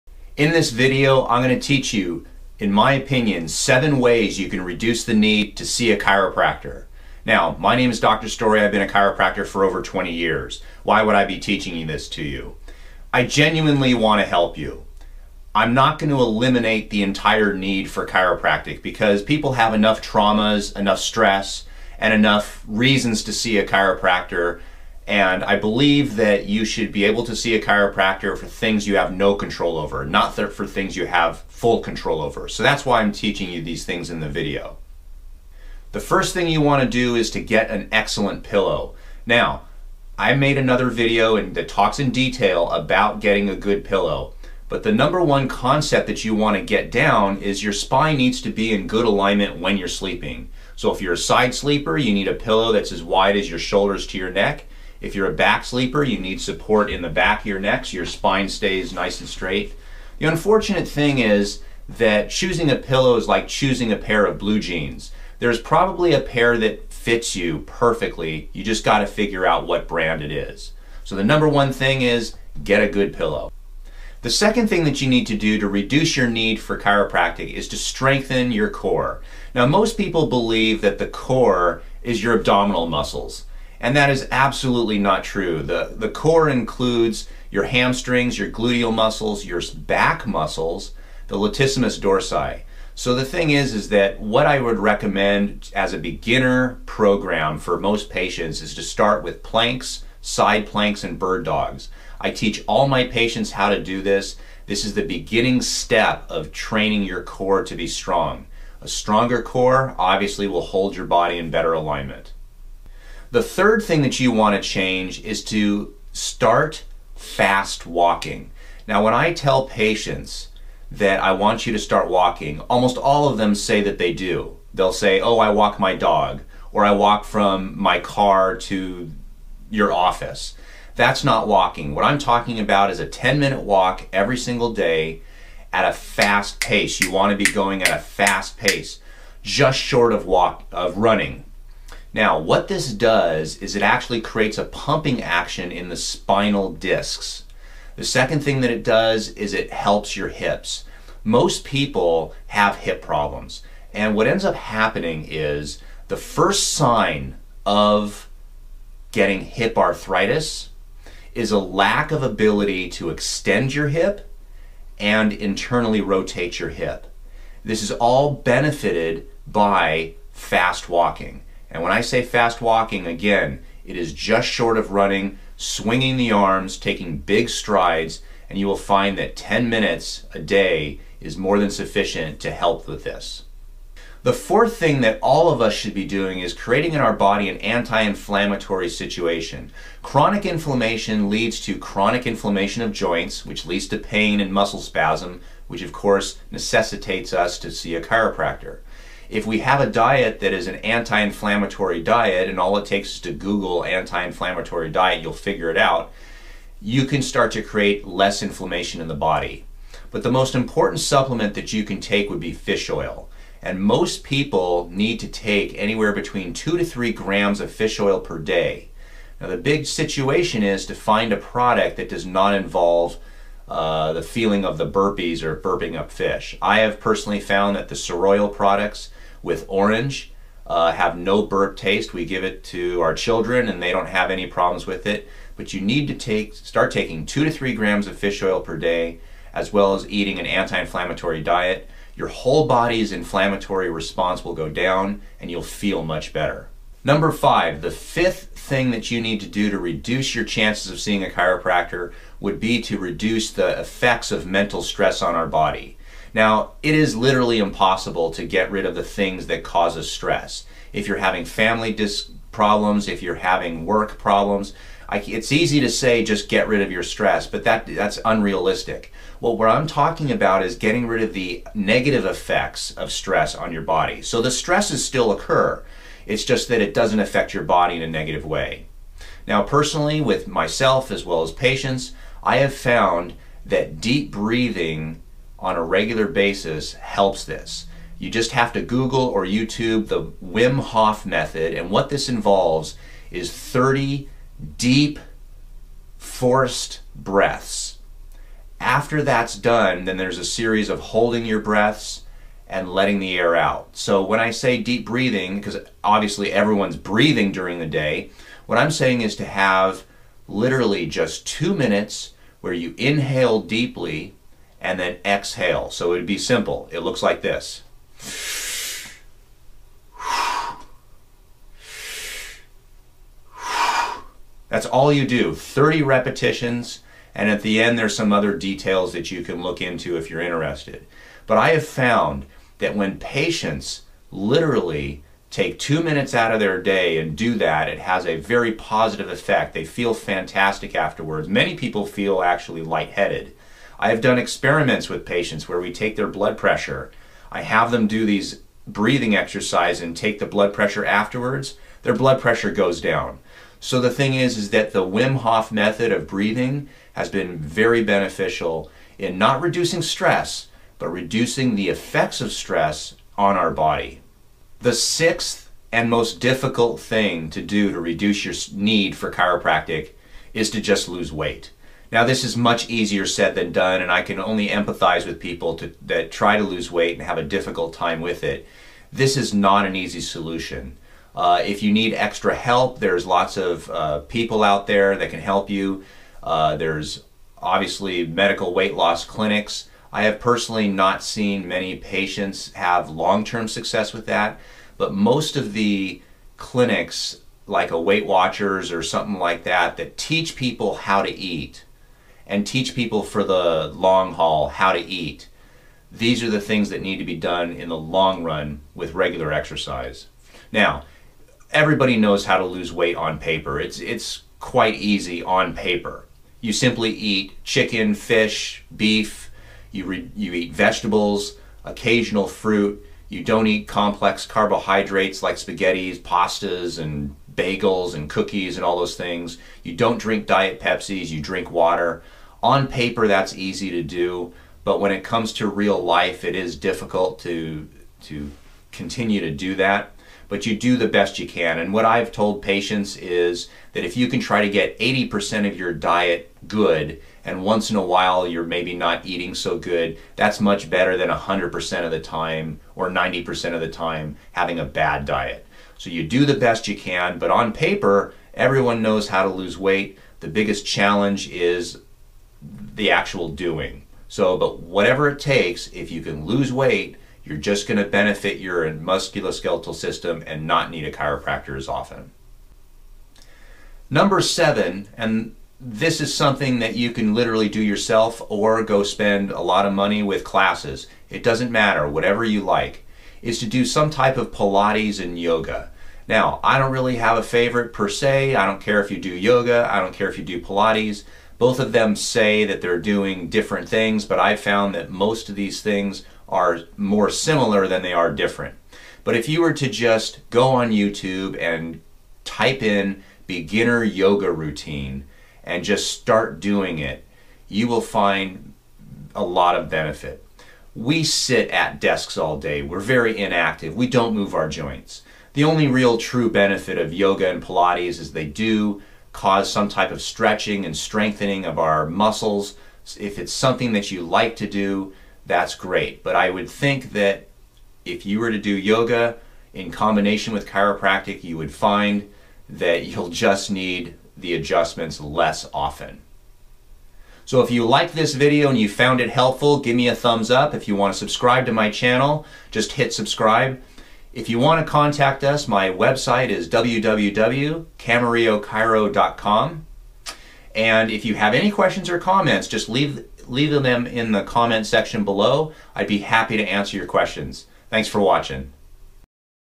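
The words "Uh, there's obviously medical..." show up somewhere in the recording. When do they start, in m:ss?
6:26.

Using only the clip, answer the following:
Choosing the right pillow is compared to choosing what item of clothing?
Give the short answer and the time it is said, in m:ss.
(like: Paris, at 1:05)
blue jeans, at 1:04.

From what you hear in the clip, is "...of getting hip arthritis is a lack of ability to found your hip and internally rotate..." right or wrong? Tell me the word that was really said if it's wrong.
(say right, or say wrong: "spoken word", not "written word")
wrong: "extend", not "found".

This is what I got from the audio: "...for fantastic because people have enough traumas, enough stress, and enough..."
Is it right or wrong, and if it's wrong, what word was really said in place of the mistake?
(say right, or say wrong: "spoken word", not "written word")
wrong: "chiropractic", not "fantastic".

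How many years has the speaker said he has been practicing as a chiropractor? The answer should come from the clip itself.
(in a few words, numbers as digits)
over 20.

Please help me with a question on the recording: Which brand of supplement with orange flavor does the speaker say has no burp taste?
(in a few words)
Soroil.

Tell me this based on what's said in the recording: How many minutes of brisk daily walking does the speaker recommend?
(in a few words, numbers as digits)
10.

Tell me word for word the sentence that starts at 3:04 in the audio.
The fourth thing that all of us should be doing is creating in our body an anti-inflammatory situation.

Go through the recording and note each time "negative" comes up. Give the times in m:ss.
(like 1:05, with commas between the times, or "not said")
4:31, 4:38.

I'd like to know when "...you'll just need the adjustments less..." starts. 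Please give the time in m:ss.
8:53.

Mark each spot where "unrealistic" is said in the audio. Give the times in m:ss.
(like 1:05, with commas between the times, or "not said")
4:28.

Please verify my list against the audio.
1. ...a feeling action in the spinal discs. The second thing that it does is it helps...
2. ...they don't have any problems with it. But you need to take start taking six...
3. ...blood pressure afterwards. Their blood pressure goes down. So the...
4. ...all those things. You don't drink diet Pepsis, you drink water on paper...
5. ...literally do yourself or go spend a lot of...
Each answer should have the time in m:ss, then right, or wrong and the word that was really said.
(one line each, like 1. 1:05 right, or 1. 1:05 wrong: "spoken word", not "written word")
1. 2:24 wrong: "pumping", not "feeling"
2. 3:53 wrong: "two", not "six"
3. 5:50 right
4. 7:08 right
5. 7:57 right.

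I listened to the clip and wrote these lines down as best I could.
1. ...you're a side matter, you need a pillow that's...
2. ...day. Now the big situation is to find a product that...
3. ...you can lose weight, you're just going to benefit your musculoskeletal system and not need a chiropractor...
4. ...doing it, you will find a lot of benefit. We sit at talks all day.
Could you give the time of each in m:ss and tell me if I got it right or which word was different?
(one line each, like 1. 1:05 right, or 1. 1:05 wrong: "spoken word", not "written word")
1. 0:51 wrong: "sleeper", not "matter"
2. 3:38 right
3. 7:46 right
4. 8:26 wrong: "desks", not "talks".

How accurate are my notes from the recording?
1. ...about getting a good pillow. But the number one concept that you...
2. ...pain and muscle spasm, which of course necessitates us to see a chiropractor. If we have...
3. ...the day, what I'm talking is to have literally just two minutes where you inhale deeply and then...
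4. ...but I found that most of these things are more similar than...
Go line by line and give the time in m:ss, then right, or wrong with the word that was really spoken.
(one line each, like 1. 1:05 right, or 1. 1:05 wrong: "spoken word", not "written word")
1. 0:42 right
2. 3:13 right
3. 5:07 wrong: "saying", not "talking"
4. 8:14 right.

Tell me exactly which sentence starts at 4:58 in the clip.
After that's done, then there's a series of holding your breaths and letting the air out.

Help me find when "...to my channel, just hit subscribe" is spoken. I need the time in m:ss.
9:01.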